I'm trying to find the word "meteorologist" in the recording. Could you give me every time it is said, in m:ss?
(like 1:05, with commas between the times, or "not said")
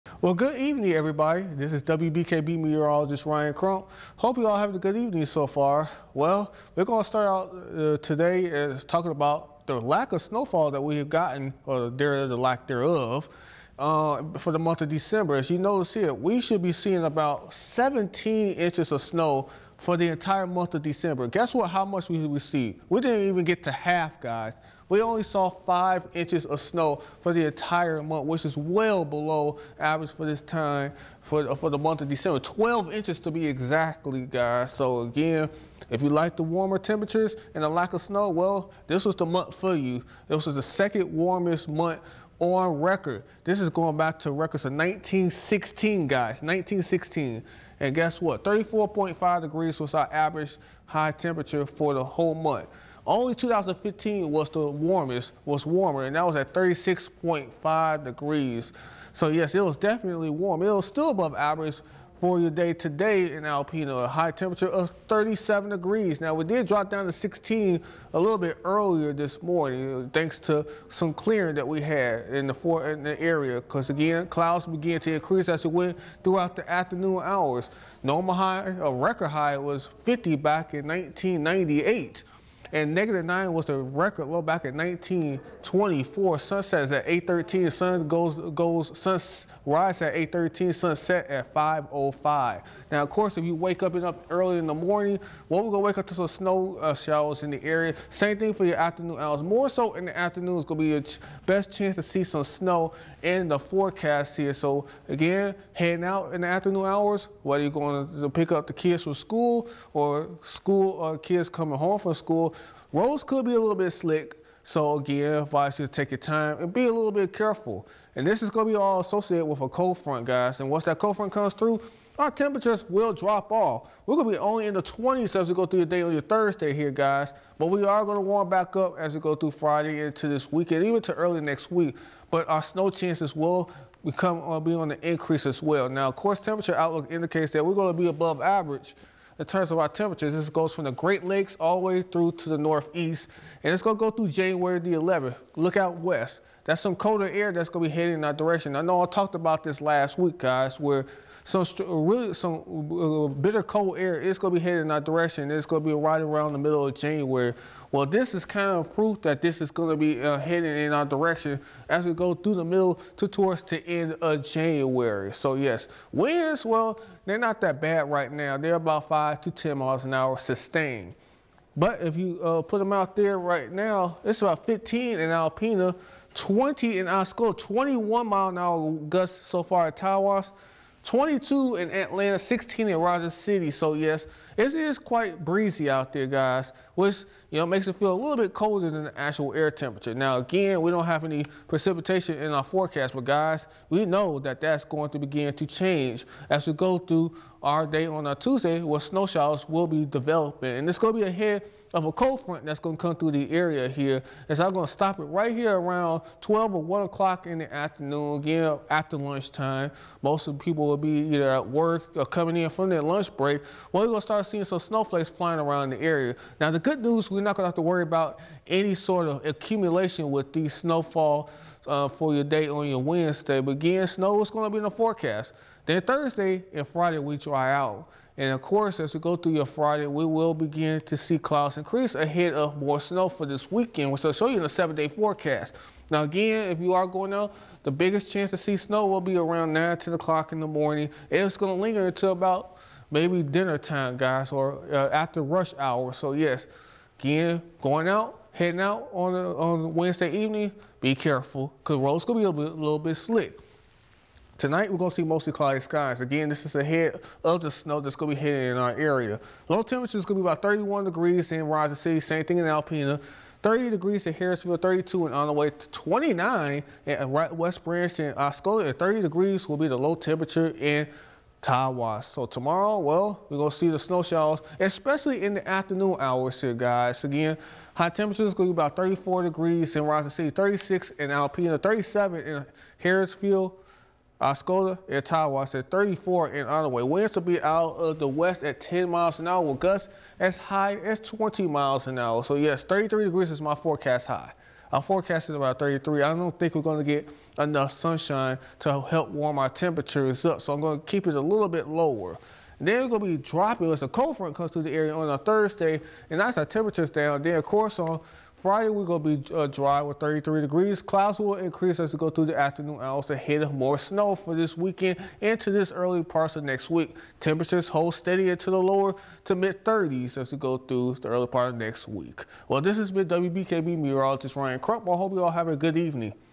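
0:02, 5:23.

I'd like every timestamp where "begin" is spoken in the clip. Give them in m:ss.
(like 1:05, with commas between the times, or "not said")
3:15, 3:50.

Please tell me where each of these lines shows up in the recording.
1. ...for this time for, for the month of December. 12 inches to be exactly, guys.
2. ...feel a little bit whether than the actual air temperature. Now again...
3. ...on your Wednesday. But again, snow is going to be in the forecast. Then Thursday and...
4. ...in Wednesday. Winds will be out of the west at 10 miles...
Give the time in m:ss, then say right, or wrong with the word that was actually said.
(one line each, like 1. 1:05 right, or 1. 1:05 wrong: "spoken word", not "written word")
1. 0:30 right
2. 3:07 wrong: "colder", not "whether"
3. 3:42 right
4. 4:46 wrong: "Onaway", not "Wednesday".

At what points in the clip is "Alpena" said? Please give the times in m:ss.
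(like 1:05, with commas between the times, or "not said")
1:03, 2:55, 4:22, 4:41.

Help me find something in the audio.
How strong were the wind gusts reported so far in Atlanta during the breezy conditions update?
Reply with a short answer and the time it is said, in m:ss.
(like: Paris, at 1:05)
22 mph, at 3:01.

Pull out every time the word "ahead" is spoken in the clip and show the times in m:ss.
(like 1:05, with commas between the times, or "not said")
3:21, 3:52, 4:16.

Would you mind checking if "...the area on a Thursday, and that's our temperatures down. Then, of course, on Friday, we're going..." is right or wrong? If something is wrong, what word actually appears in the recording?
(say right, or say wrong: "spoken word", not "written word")
right.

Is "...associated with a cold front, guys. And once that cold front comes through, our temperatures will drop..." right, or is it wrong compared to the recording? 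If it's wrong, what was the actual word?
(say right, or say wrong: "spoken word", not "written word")
right.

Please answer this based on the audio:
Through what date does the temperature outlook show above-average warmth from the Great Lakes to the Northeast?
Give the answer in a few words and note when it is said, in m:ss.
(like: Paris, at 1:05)
January 11, at 2:24.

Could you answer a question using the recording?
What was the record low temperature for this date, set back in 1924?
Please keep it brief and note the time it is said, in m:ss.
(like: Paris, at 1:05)
-9, at 1:22.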